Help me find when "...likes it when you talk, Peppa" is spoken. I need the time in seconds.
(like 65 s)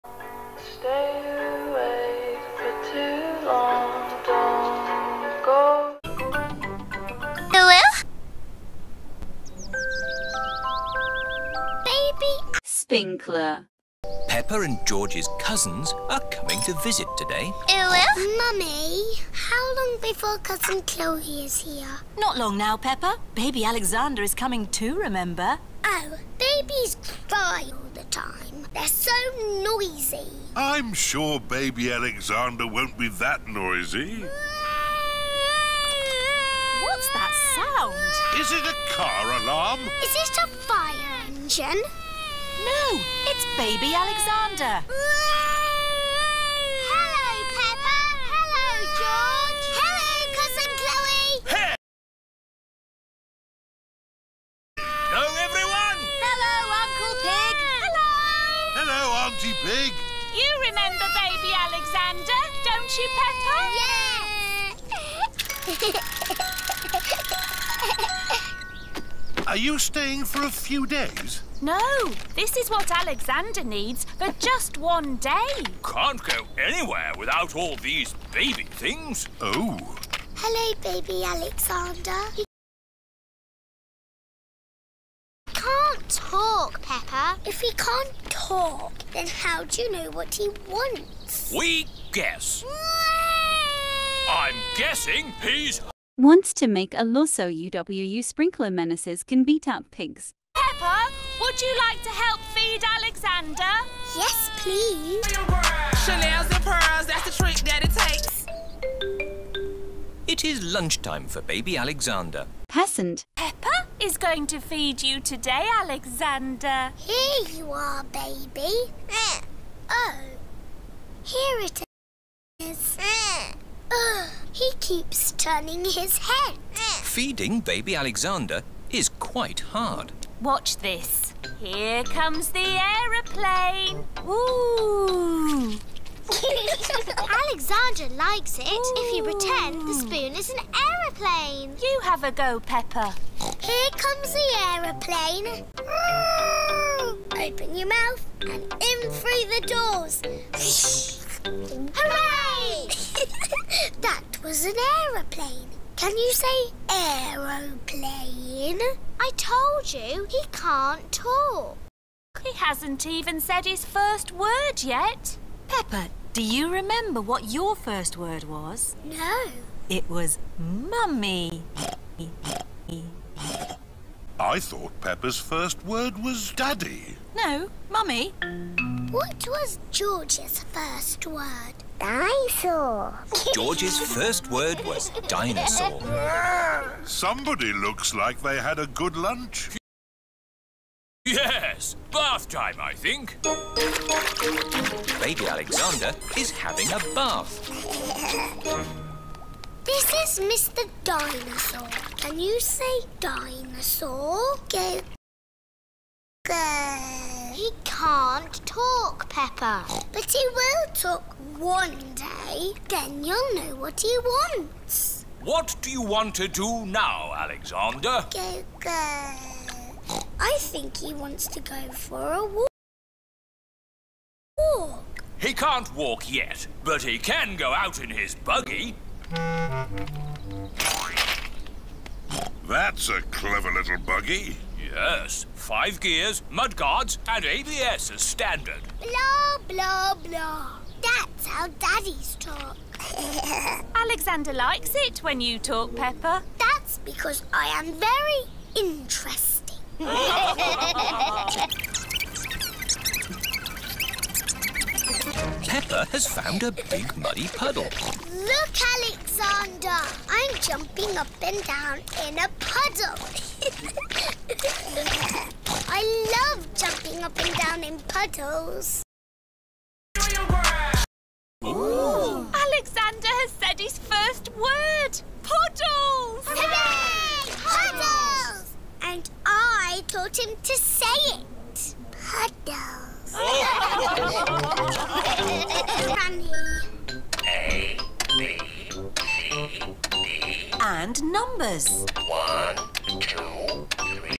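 244 s.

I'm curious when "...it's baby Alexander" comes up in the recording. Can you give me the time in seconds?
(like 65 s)
43 s.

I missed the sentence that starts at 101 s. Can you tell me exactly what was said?
Would you like to help feed Alexander?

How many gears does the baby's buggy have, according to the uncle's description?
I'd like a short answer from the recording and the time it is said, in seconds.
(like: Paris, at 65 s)
5, at 235 s.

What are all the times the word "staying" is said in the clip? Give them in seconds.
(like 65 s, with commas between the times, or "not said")
69 s.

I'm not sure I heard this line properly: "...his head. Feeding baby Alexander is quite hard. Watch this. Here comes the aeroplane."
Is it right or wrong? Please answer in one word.
right.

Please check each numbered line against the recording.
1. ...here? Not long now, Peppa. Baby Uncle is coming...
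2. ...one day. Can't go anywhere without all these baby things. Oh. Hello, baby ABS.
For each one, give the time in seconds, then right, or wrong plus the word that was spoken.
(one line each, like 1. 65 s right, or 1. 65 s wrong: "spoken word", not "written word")
1. 21 s wrong: "Alexander", not "Uncle"
2. 74 s wrong: "Alexander", not "ABS".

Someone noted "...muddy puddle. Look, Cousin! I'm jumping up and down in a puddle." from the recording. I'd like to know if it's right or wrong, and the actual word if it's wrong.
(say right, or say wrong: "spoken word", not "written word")
wrong: "Alexander", not "Cousin".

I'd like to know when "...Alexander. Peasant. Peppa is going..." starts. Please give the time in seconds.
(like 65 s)
111 s.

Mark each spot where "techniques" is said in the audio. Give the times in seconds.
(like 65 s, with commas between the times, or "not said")
not said.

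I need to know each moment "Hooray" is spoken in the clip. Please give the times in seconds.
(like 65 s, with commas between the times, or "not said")
151 s, 276 s.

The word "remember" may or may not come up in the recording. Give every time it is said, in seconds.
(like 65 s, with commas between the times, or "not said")
24 s, 60 s, 166 s.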